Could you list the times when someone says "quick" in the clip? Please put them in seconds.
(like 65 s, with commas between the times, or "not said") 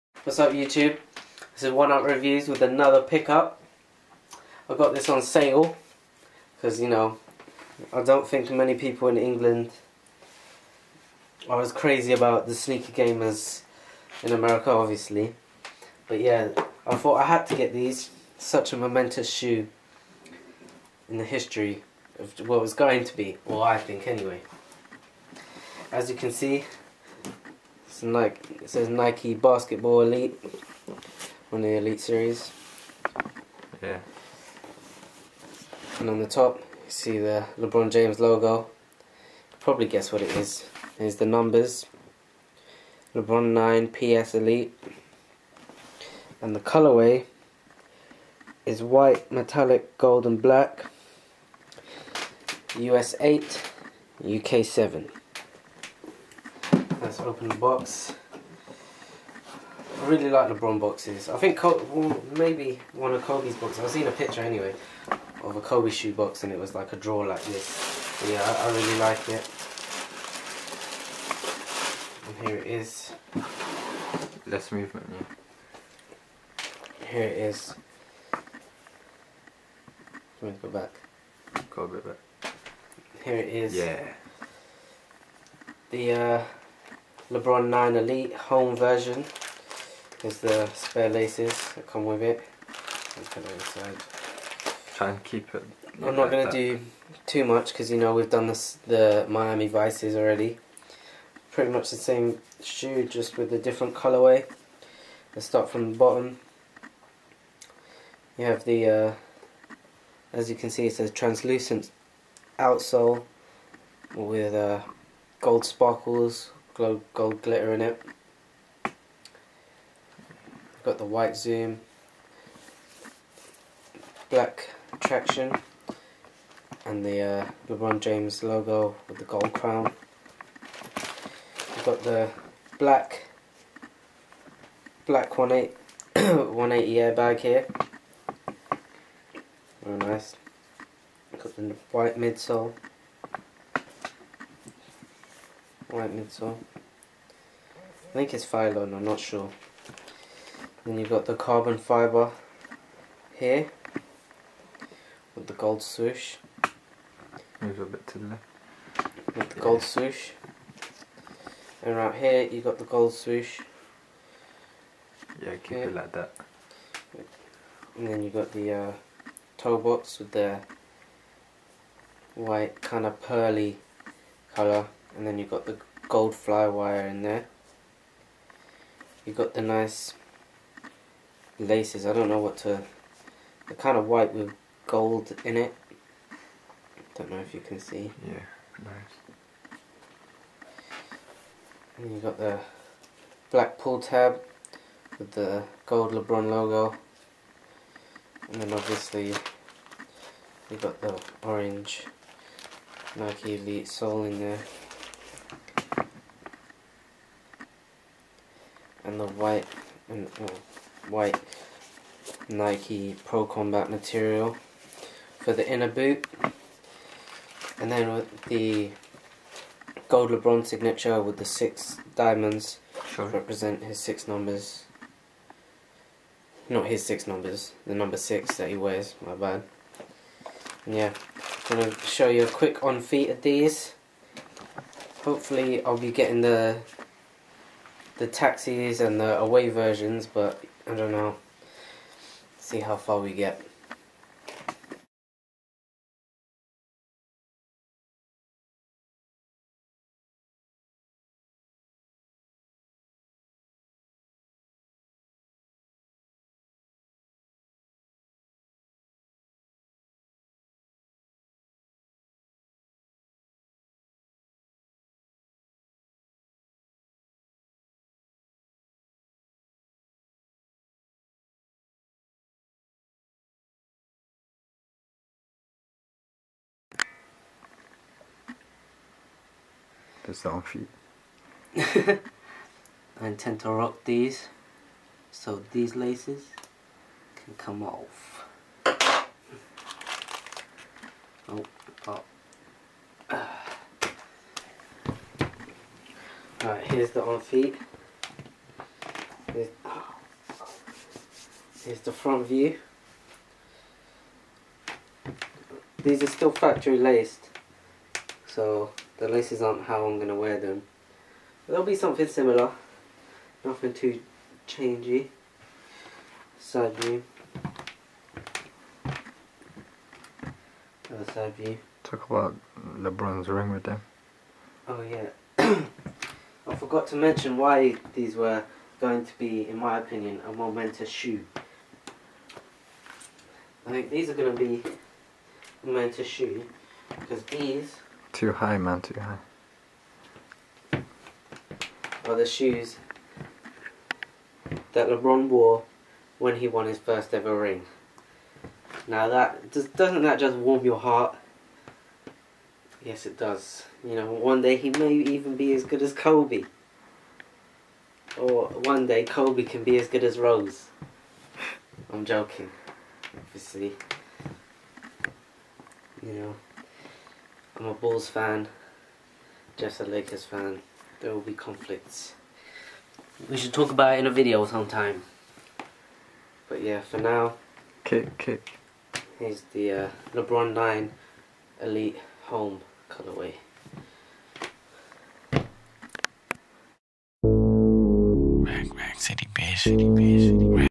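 232 s.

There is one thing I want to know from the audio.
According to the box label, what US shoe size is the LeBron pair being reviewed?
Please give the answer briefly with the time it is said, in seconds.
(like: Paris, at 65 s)
8, at 52 s.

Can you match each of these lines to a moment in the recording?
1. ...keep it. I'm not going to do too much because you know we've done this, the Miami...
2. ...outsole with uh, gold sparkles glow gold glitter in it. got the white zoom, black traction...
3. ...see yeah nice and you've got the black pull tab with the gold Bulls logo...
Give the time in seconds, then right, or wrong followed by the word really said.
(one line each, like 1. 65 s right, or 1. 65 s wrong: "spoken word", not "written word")
1. 95 s right
2. 112 s right
3. 187 s wrong: "LeBron", not "Bulls".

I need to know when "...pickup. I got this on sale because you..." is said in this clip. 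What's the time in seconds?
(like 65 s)
3 s.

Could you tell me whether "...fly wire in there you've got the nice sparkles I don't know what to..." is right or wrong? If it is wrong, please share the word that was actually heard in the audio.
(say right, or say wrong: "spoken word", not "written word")
wrong: "laces", not "sparkles".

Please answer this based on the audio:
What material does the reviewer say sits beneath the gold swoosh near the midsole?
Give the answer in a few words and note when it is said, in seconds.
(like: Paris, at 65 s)
carbon fibre, at 151 s.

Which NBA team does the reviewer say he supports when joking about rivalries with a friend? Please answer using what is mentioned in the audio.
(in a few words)
Bulls.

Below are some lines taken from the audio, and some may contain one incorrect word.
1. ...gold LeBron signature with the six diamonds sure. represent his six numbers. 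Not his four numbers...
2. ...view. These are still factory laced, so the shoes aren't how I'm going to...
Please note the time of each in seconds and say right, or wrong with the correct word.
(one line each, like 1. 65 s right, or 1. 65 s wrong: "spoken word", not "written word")
1. 220 s wrong: "six", not "four"
2. 302 s wrong: "laces", not "shoes".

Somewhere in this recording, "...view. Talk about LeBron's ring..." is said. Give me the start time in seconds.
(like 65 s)
321 s.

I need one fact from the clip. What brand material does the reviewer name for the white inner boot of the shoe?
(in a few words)
Nike Pro Combat.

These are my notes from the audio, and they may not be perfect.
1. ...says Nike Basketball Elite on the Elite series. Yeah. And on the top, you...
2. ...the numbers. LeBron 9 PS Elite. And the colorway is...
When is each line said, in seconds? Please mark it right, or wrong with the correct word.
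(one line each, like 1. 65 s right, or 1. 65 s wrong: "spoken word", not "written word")
1. 28 s right
2. 41 s right.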